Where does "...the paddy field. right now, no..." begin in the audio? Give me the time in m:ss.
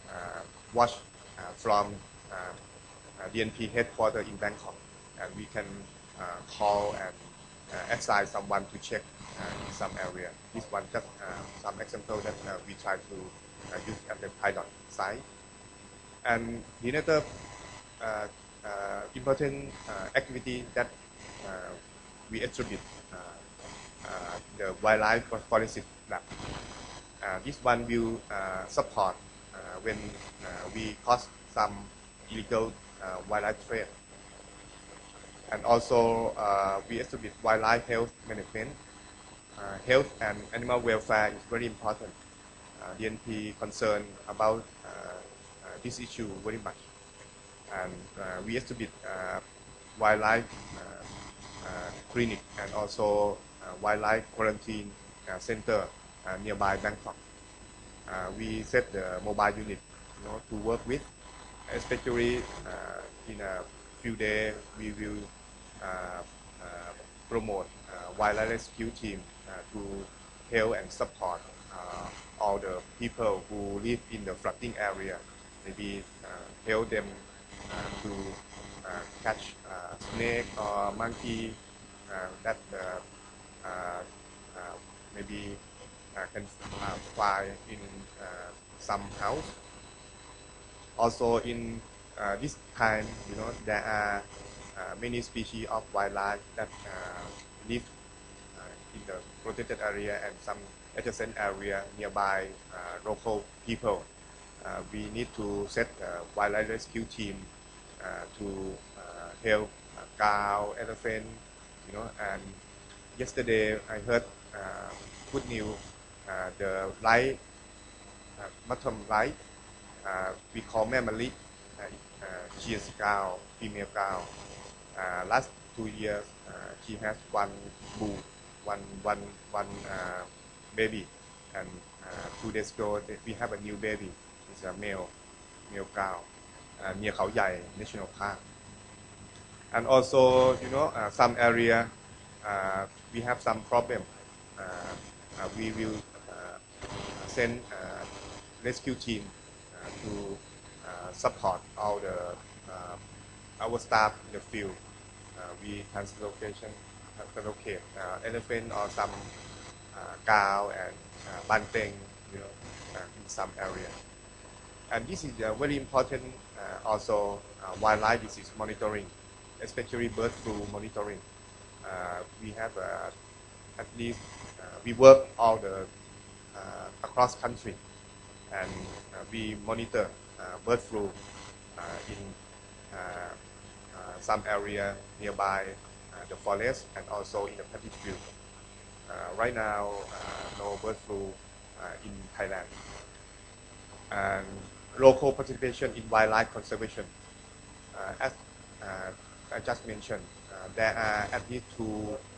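3:07.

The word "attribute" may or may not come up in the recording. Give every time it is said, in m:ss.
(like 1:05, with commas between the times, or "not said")
0:22, 0:37.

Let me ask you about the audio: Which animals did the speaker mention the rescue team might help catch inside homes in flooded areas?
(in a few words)
Snake or monkey.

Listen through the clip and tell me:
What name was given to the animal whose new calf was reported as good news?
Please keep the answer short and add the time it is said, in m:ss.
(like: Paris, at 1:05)
Mamali, at 2:00.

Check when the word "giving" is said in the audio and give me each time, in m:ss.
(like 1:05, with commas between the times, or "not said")
not said.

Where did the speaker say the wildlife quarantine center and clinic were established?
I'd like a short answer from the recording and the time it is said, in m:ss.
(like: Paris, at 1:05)
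Nearby Bangkok, at 0:56.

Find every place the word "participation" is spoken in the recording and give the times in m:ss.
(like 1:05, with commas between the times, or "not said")
3:15.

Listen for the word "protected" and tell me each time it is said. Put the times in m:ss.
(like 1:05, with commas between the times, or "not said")
1:39.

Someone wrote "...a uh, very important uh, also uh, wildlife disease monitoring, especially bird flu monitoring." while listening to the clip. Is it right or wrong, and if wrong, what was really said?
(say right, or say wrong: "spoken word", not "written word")
right.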